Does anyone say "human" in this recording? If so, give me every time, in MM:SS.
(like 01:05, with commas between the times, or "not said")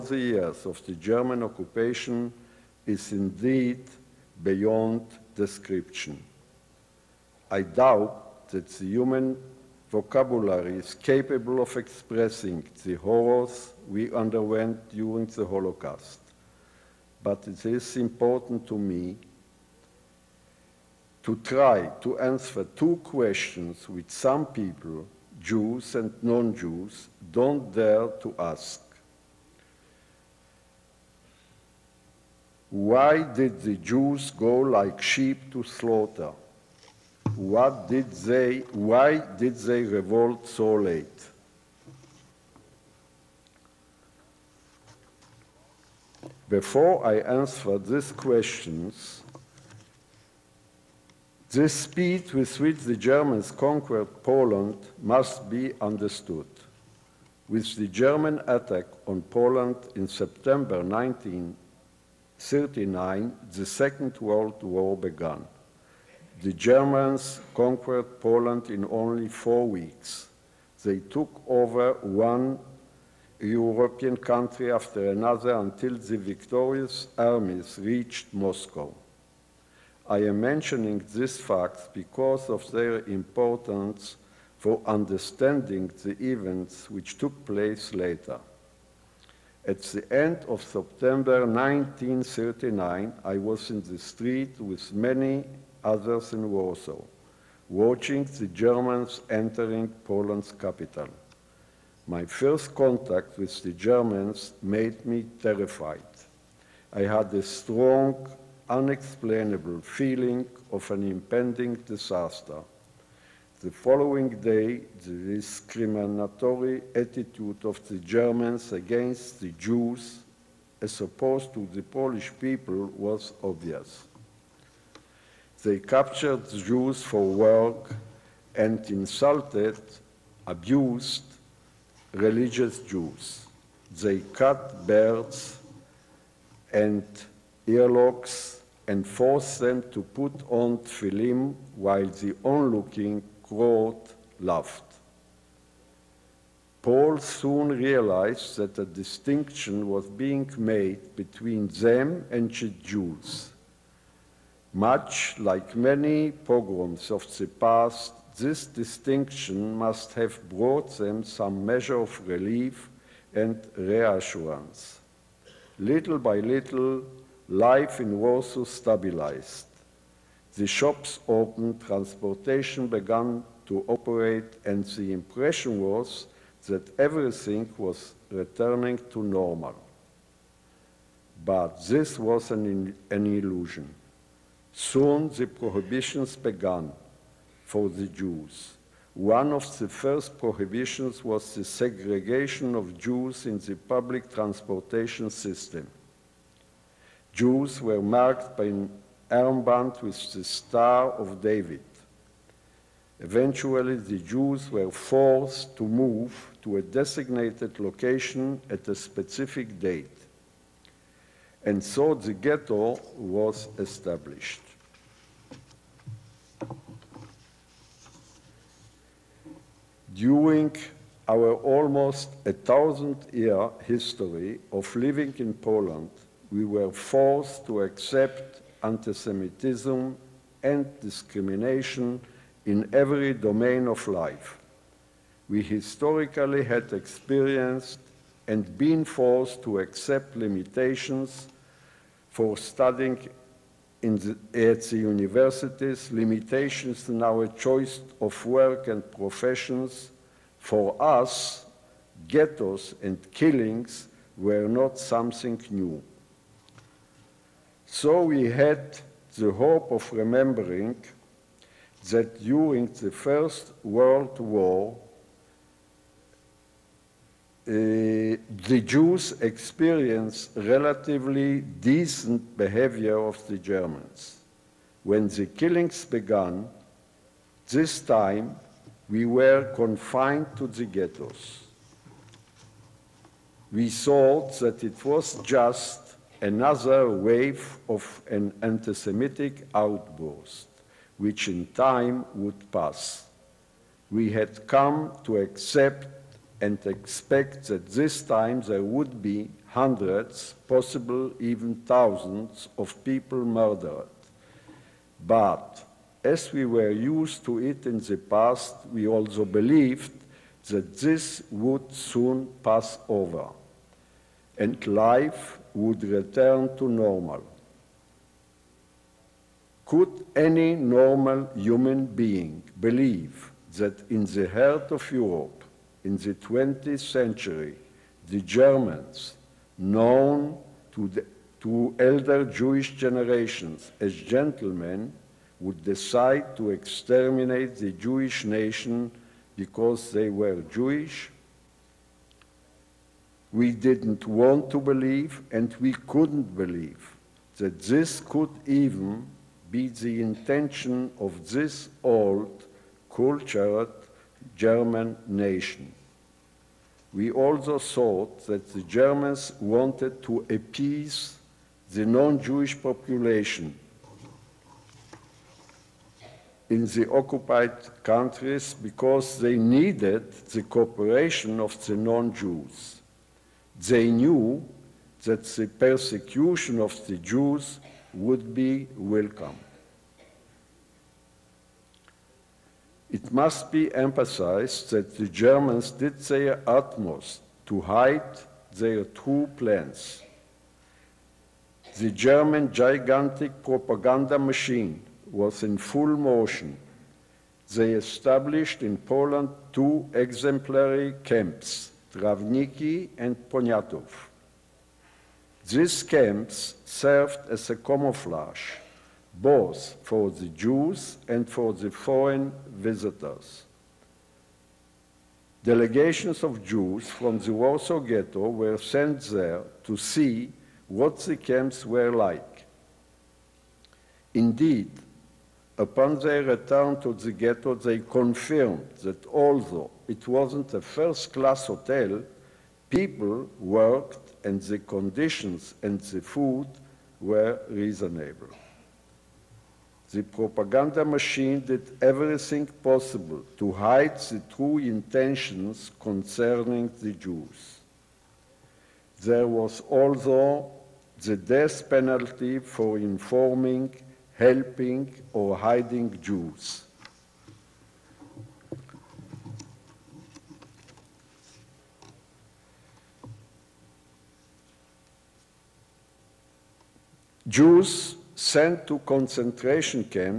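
00:08, 05:21.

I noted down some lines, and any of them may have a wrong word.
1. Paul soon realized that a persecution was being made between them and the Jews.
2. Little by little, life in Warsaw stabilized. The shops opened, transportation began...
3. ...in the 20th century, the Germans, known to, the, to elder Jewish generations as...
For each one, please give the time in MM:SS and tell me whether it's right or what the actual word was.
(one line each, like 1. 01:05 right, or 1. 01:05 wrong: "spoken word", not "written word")
1. 02:26 wrong: "distinction", not "persecution"
2. 02:45 right
3. 05:26 right.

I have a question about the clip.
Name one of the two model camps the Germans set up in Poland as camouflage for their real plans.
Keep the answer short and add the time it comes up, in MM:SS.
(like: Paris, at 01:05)
Trawniki, at 06:42.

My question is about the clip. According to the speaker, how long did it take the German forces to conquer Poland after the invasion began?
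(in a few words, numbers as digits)
4 weeks.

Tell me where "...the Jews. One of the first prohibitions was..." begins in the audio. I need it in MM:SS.
03:07.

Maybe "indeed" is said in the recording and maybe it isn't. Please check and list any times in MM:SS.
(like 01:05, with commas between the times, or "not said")
00:03, 07:04.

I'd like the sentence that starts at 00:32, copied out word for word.
Why did the Jews go like sheep to slaughter?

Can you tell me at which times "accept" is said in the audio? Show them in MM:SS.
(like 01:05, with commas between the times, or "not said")
03:47, 03:59, 04:55.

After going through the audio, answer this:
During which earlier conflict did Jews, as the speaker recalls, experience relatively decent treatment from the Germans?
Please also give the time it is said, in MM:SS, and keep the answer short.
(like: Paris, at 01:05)
First World War, at 04:23.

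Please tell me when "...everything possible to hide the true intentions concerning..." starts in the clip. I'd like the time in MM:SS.
07:22.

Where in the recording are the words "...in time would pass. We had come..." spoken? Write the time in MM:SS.
04:51.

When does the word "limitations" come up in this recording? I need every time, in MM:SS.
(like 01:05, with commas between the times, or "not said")
04:00, 04:06.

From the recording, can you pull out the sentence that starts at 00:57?
With the German attack on Poland in September 1939, the Second World War began.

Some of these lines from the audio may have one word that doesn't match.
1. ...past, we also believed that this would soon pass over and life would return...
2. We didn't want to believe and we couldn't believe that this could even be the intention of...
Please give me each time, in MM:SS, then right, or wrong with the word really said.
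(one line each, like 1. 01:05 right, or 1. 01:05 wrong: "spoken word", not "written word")
1. 05:08 right
2. 05:43 right.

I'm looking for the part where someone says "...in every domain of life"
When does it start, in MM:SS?
03:52.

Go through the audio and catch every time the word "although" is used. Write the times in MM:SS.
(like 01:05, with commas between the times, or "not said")
07:09.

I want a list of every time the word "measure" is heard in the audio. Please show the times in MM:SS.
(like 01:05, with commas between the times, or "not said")
02:41.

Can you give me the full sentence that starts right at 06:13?
They knew that the persecution of the Jews would be welcome.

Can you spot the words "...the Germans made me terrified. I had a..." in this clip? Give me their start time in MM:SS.
01:43.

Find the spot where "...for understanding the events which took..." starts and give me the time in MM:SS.
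01:24.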